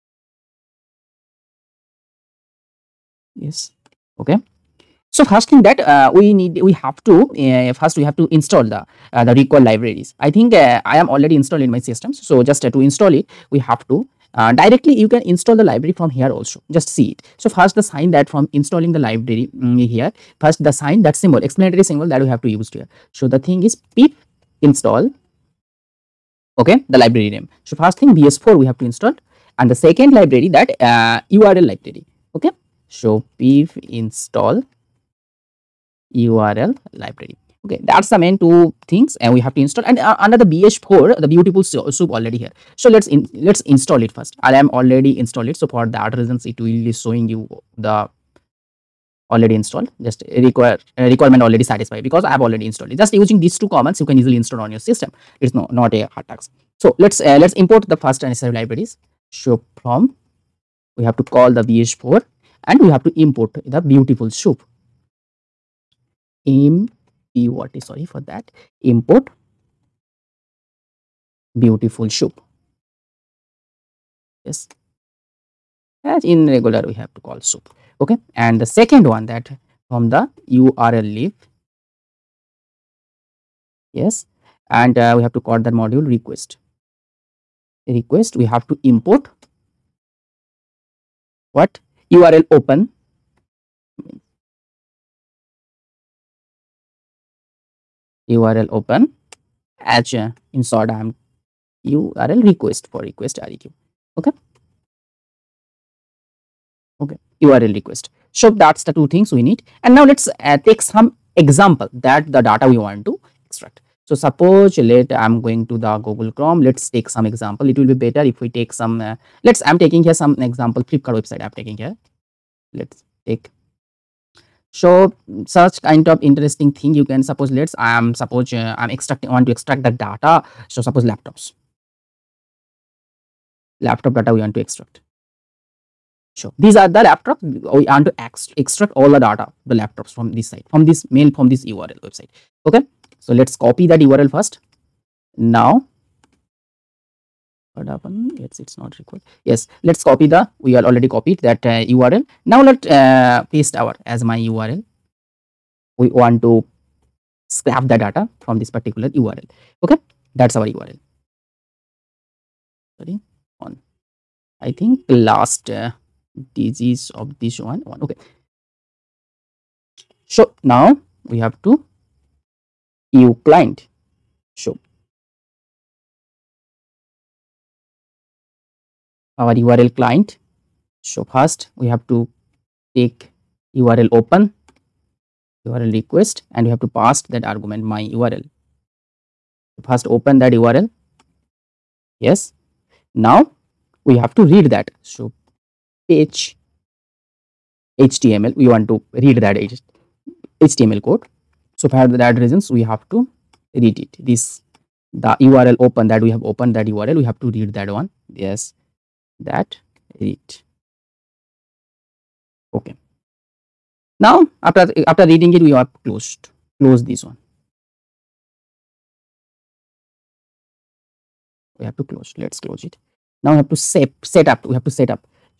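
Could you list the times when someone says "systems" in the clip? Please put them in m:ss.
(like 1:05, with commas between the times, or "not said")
0:11, 0:54.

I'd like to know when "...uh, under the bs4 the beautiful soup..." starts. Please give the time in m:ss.
0:39.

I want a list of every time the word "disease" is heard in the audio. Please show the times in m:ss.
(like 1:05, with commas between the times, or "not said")
2:46.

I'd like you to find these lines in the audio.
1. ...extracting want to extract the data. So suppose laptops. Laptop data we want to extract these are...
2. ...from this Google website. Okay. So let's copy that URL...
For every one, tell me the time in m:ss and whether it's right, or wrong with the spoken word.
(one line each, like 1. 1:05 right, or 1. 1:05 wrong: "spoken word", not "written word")
1. 2:08 right
2. 2:21 wrong: "URL", not "Google".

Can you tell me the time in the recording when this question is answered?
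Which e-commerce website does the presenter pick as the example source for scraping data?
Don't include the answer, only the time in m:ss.
2:00.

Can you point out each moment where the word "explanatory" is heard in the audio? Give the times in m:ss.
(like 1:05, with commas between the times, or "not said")
0:21.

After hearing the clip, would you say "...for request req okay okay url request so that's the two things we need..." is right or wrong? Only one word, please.
right.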